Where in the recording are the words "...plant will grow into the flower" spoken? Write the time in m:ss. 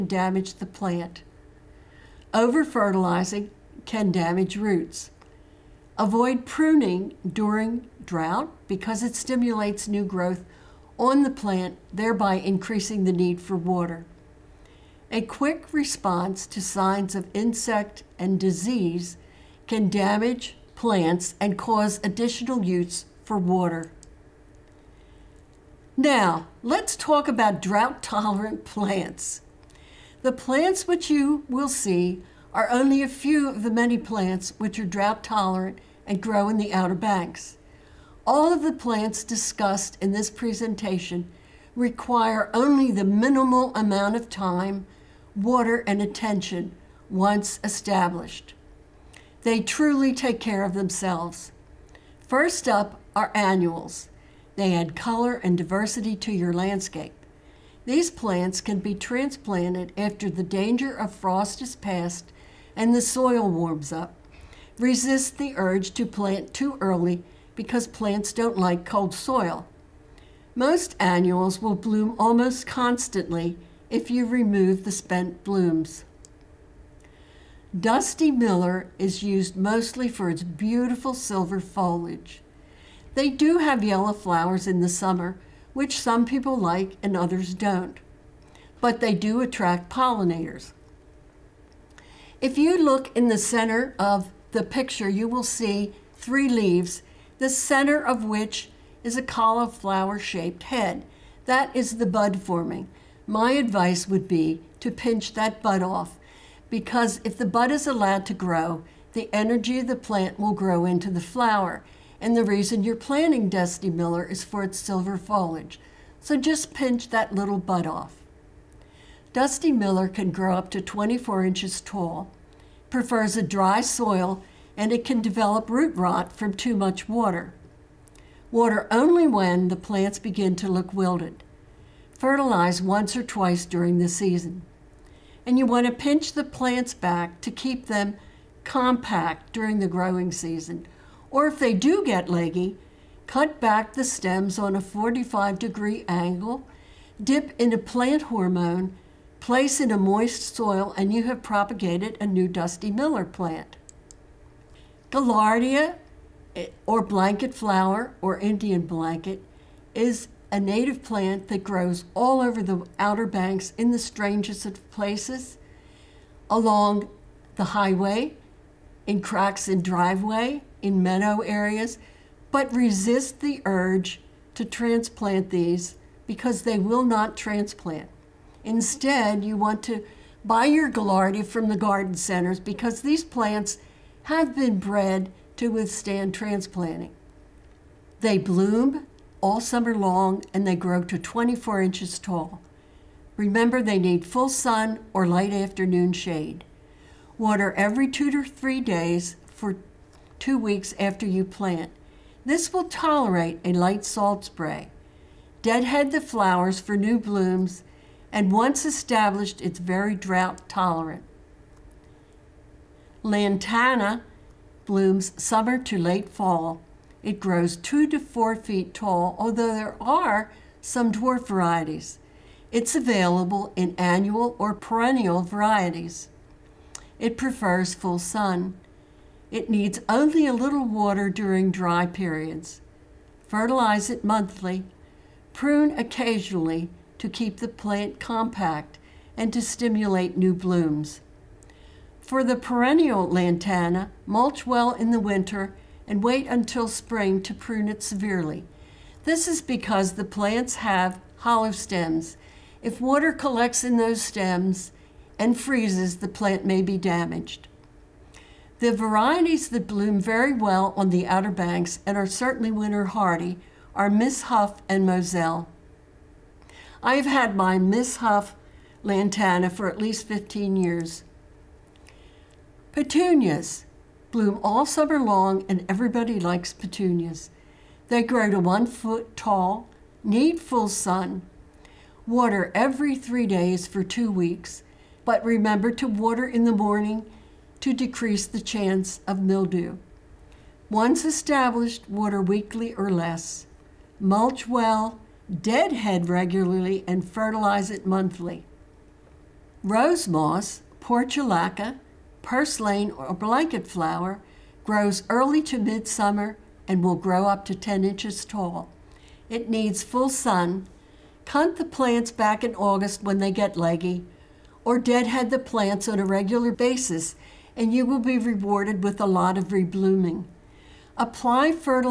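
1:49.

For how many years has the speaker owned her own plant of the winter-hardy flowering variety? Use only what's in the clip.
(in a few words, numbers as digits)
15.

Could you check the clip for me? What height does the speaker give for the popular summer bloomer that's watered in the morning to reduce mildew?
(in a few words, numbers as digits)
1 foot.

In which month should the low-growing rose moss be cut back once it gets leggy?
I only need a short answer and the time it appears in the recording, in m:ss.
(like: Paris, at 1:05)
August, at 5:12.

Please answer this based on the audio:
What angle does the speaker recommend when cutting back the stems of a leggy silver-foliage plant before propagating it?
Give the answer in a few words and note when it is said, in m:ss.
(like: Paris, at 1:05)
45 degrees, at 2:24.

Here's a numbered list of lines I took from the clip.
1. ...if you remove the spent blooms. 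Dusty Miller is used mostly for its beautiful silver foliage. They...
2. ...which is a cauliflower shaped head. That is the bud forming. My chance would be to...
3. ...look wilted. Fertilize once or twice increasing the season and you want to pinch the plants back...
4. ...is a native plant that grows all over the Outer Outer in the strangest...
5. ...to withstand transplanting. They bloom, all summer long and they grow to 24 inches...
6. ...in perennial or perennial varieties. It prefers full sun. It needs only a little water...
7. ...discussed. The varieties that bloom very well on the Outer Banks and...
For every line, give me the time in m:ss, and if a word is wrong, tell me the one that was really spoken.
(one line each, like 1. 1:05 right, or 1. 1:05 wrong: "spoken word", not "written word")
1. 1:13 right
2. 1:38 wrong: "advice", not "chance"
3. 2:10 wrong: "during", not "increasing"
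4. 2:39 wrong: "Banks", not "Outer"
5. 3:05 right
6. 3:43 wrong: "annual", not "perennial"
7. 4:16 wrong: "damaged", not "discussed".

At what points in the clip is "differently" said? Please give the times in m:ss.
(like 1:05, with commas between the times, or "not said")
not said.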